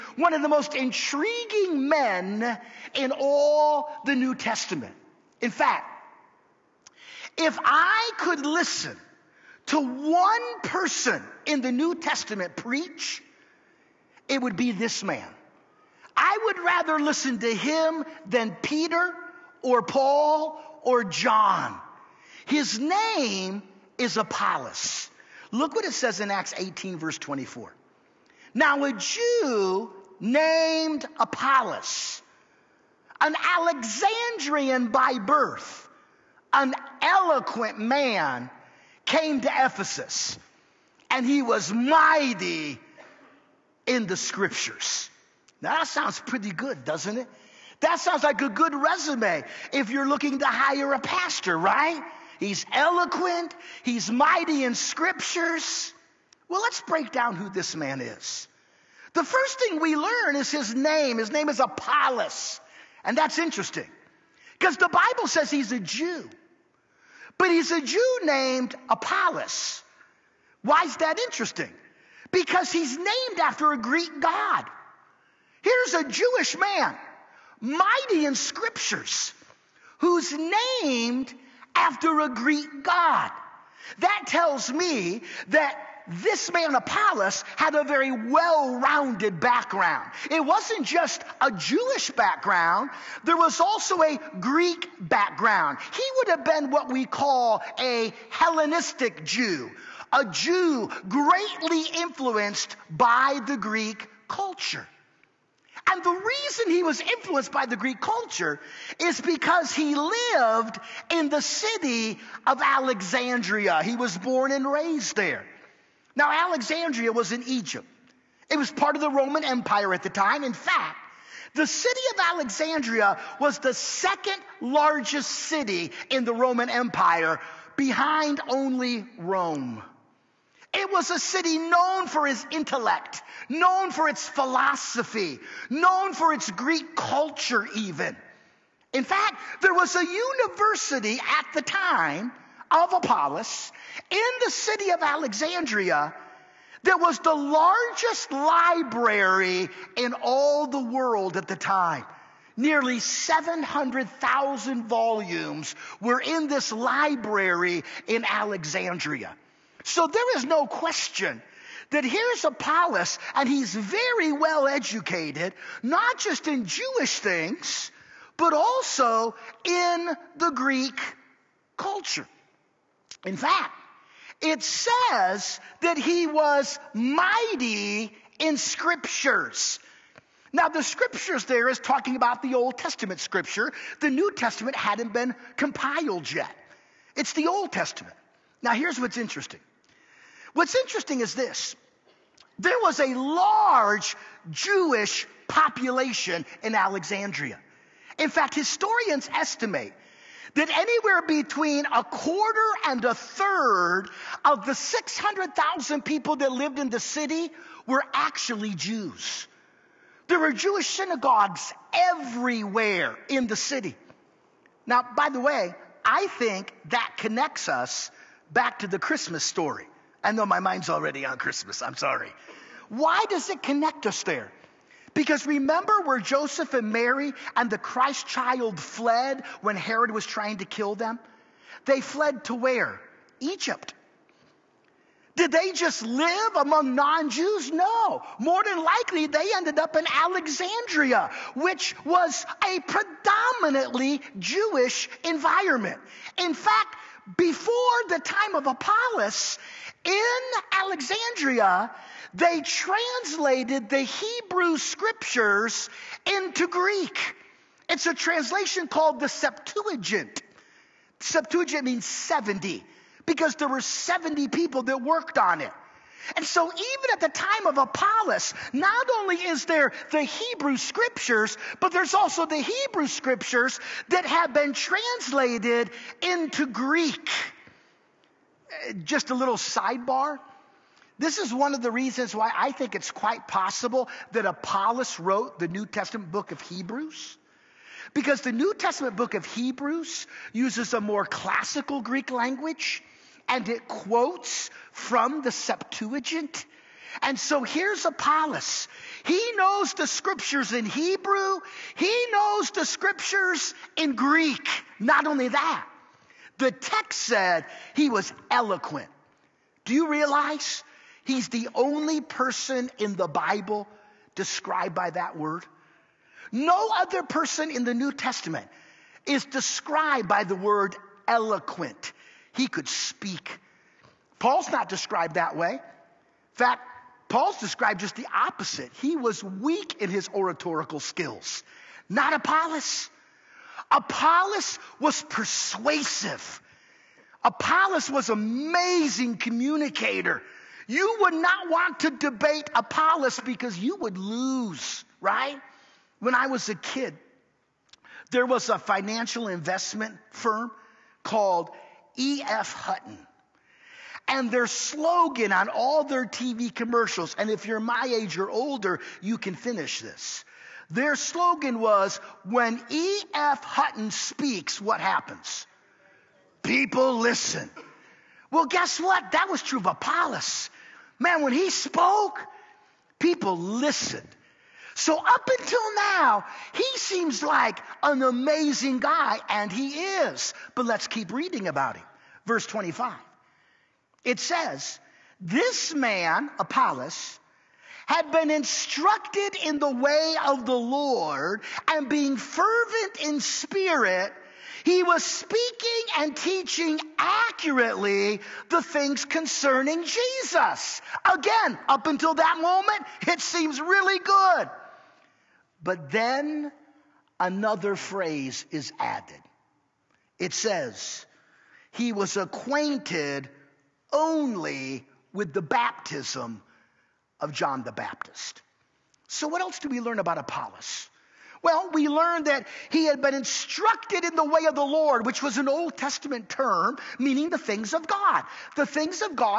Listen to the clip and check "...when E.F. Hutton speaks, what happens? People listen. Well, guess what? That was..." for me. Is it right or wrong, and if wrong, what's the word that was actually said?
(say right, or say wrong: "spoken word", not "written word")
right.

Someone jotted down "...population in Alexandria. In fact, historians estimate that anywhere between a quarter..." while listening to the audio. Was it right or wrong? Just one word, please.
right.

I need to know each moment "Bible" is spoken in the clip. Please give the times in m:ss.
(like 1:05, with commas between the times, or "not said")
1:04, 5:13.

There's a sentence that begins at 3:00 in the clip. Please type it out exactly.
Now, the scriptures there is talking about the Old Testament scripture.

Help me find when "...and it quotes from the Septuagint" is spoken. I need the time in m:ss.
4:53.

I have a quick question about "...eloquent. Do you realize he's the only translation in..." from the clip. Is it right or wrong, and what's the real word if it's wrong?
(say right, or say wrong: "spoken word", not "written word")
wrong: "person", not "translation".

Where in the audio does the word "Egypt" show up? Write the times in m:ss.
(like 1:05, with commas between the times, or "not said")
1:57, 3:53.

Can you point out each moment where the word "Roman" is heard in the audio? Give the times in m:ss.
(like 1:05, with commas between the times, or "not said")
1:59, 2:06.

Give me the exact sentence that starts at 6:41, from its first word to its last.
Again, up until that moment, it seems really good.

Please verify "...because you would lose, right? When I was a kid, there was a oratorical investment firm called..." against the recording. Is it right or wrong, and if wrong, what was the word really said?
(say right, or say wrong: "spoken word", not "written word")
wrong: "financial", not "oratorical".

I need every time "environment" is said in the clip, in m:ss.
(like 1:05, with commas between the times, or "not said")
4:05.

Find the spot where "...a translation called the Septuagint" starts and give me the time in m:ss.
4:18.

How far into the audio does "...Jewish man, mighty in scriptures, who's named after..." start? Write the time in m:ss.
1:16.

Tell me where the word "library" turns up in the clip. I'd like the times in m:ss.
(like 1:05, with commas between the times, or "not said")
2:28, 2:36.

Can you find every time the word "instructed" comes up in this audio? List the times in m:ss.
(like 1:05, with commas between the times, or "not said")
6:28, 7:03.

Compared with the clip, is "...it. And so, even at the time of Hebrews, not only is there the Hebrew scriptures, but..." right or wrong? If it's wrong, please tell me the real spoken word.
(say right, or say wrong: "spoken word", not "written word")
wrong: "Apollos", not "Hebrews".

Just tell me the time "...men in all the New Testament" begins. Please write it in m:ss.
0:01.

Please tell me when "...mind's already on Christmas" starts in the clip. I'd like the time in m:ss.
3:40.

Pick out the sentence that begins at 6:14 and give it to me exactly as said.
So up until now, he seems like an amazing guy, and he is.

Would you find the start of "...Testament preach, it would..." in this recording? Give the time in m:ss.
0:11.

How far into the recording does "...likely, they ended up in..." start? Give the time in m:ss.
3:58.